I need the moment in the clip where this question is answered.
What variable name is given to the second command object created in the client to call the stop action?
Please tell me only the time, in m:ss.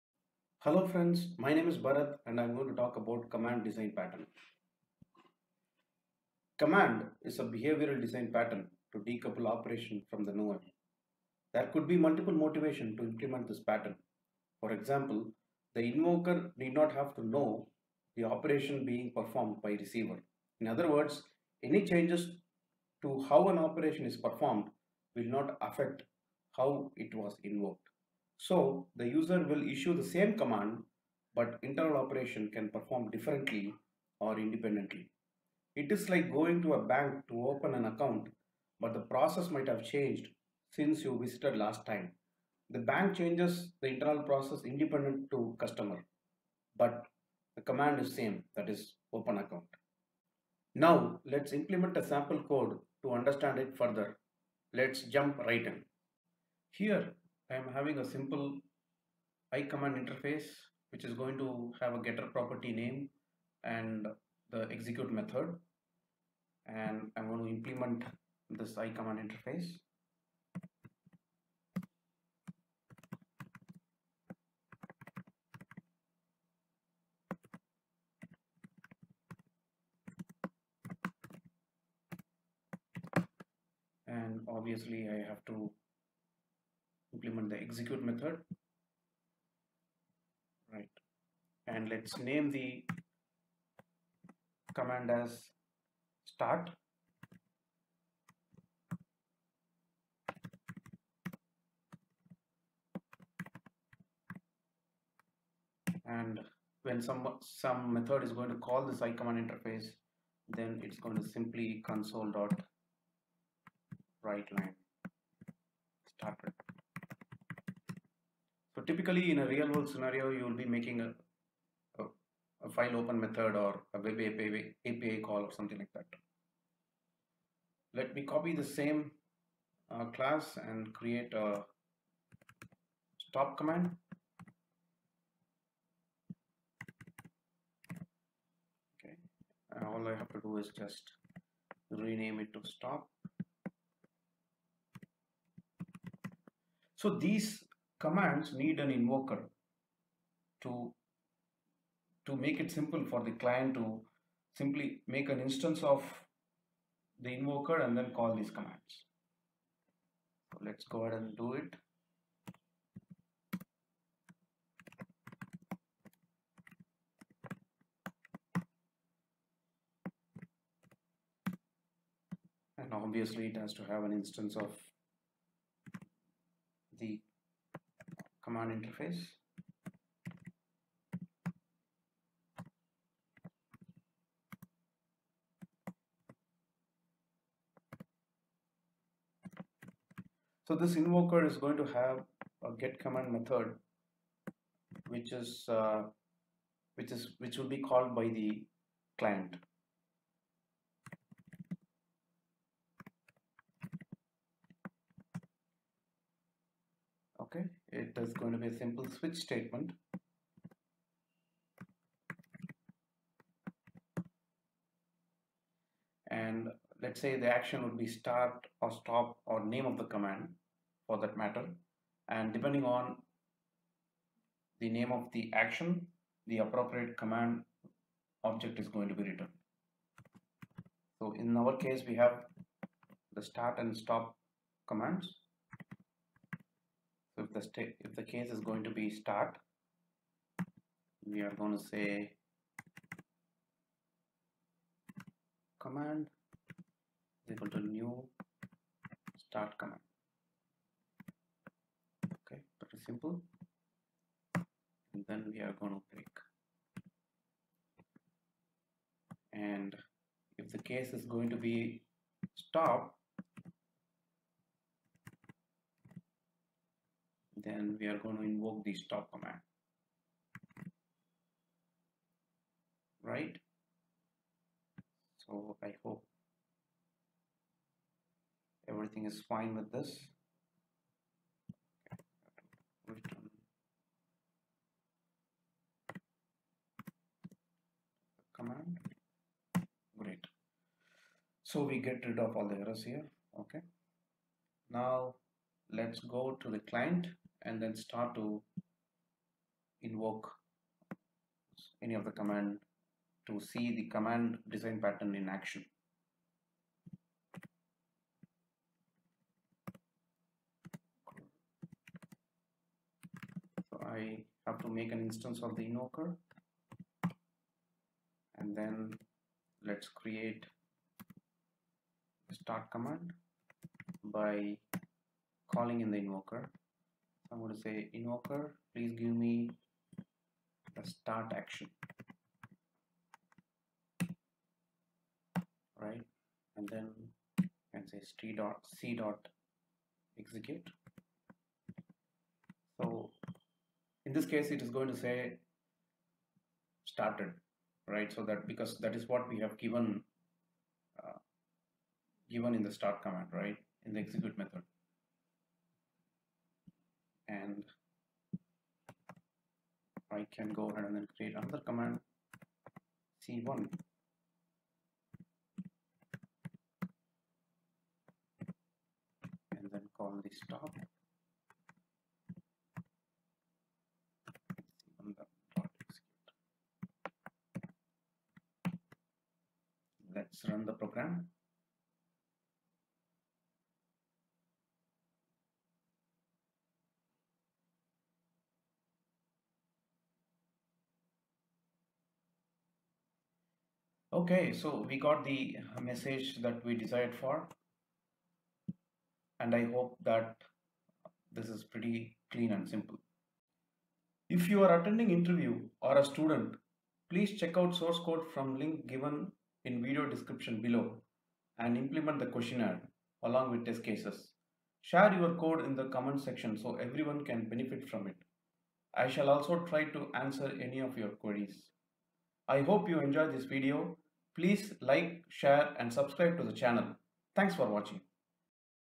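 6:03.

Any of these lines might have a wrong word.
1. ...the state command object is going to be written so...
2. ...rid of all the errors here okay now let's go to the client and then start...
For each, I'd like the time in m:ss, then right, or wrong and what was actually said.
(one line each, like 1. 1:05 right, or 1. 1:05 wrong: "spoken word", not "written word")
1. 3:46 wrong: "appropriate", not "state"
2. 4:52 right.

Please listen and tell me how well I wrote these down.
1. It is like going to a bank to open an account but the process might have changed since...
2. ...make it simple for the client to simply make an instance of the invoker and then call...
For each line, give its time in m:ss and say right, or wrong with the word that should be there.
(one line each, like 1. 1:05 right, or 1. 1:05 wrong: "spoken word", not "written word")
1. 0:35 right
2. 2:32 right.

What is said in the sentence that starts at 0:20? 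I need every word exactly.
In other words, any changes to how an operation is performed will not affect how it was invoked.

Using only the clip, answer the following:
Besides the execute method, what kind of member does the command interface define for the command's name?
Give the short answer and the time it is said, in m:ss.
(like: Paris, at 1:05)
getter property, at 1:02.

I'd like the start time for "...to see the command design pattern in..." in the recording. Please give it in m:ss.
5:03.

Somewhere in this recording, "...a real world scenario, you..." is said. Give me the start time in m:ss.
1:59.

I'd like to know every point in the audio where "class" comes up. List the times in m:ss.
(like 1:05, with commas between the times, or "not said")
2:10.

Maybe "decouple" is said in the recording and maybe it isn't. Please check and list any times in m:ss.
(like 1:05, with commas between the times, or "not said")
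0:08.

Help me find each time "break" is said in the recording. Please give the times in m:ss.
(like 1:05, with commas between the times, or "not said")
4:16.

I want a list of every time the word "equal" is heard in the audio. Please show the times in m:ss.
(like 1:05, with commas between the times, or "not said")
4:07.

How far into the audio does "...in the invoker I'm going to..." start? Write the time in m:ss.
5:26.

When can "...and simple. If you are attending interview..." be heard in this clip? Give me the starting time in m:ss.
6:42.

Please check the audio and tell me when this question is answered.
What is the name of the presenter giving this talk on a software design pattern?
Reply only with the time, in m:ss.
0:01.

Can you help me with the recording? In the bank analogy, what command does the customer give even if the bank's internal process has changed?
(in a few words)
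open account.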